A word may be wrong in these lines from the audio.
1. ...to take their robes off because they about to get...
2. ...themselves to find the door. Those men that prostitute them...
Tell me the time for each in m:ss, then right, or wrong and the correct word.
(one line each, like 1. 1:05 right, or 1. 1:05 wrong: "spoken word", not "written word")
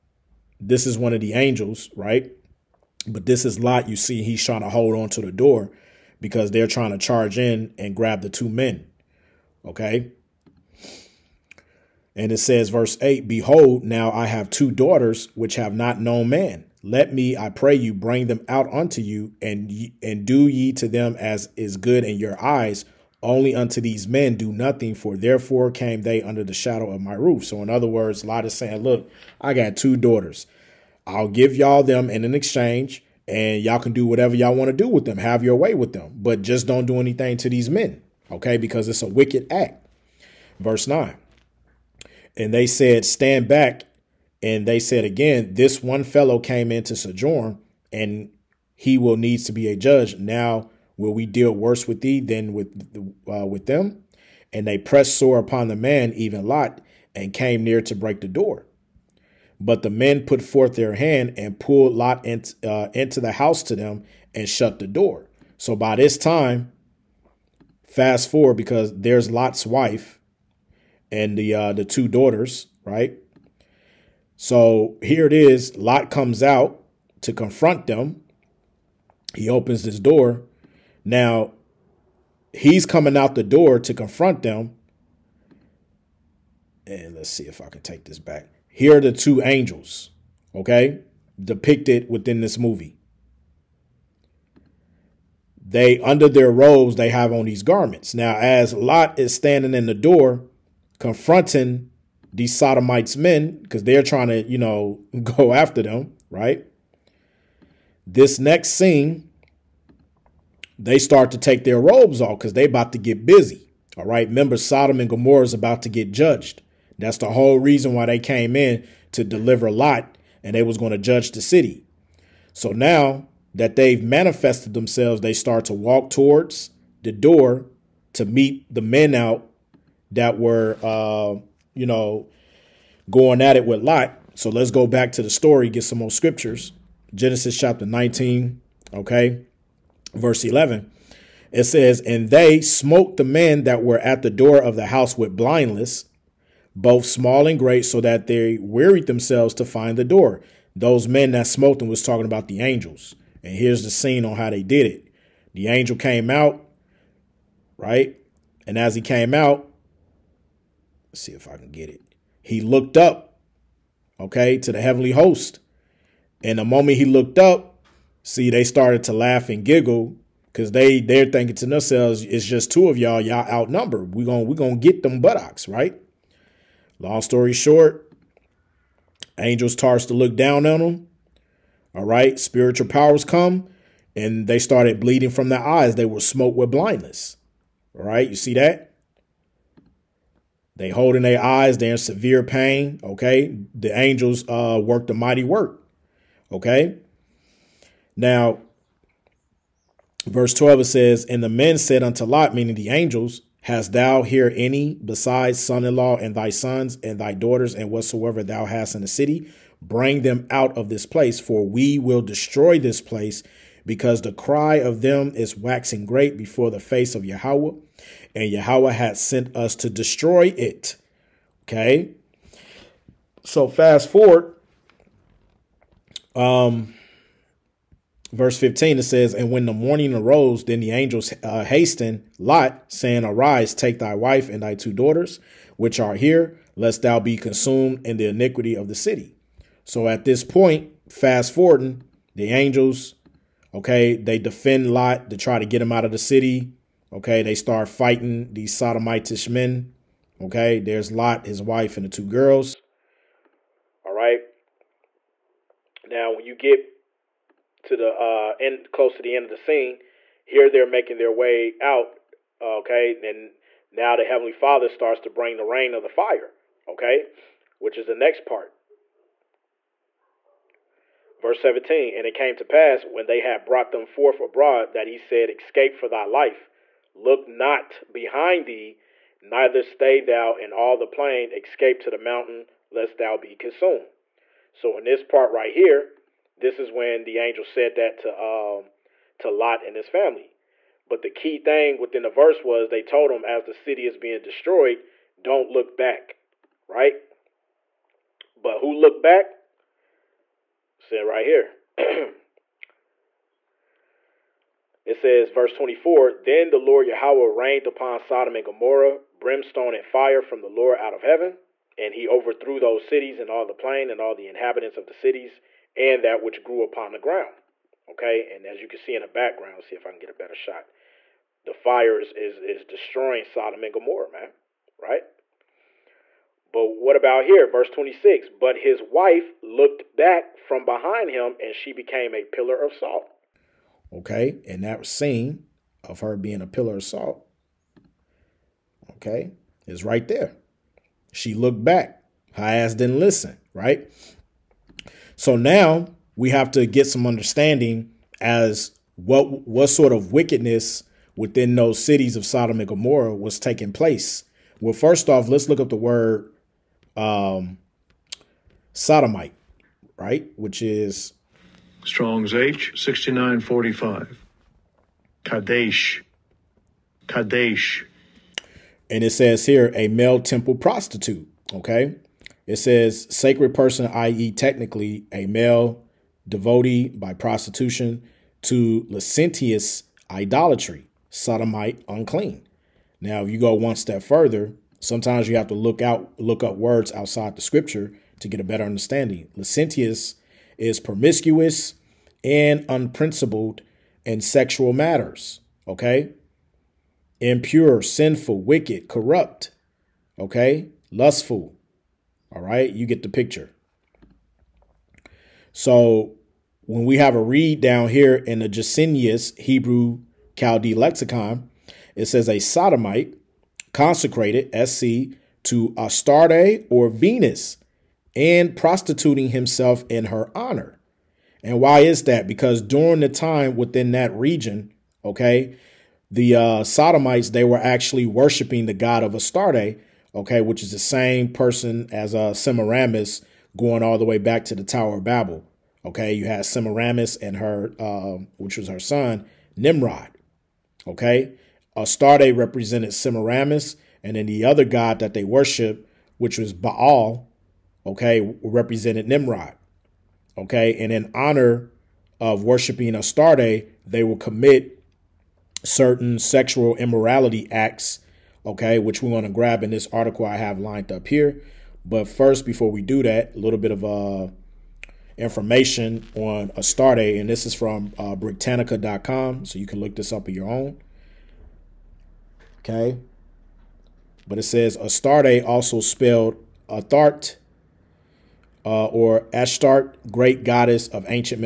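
1. 1:51 right
2. 2:29 wrong: "smote", not "prostitute".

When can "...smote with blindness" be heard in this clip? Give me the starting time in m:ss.
3:06.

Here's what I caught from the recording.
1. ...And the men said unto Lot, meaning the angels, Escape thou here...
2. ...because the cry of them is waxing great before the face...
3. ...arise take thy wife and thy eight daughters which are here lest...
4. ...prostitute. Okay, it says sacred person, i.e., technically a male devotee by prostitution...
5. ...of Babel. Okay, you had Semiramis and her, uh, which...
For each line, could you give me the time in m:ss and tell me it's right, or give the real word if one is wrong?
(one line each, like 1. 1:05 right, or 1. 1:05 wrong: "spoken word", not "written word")
1. 3:21 wrong: "Hast", not "Escape"
2. 3:33 right
3. 3:53 wrong: "two", not "eight"
4. 6:10 right
5. 7:15 right.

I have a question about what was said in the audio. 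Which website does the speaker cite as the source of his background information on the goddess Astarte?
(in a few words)
Britannica.com.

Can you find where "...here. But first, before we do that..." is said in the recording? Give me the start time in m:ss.
7:41.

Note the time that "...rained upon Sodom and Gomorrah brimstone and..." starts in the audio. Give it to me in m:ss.
5:07.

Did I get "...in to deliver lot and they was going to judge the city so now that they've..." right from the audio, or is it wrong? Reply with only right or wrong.
right.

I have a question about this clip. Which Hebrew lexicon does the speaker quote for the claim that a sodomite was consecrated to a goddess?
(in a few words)
Gesenius Hebrew Chaldee lexicon.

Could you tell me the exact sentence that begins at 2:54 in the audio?
We're gonna we're gonna get them buttocks, right?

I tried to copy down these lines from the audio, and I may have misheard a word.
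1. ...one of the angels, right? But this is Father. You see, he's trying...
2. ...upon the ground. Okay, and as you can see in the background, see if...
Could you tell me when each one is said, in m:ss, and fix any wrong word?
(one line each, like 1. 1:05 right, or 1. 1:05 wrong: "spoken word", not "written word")
1. 0:00 wrong: "Lot", not "Father"
2. 5:16 right.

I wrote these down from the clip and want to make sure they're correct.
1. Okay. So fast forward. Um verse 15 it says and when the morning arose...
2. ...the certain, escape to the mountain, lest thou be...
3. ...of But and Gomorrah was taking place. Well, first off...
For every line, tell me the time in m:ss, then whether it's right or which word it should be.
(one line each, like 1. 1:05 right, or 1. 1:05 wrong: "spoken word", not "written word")
1. 3:41 right
2. 4:40 wrong: "plain", not "certain"
3. 5:52 wrong: "Sodom", not "But".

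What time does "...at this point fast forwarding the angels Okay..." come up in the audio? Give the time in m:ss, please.
4:00.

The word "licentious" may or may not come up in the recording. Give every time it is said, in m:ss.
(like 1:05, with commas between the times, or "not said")
6:19, 6:29.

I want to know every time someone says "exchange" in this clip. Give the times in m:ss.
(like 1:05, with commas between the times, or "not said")
0:32.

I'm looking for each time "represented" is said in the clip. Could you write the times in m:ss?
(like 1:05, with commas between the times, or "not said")
7:22, 7:28.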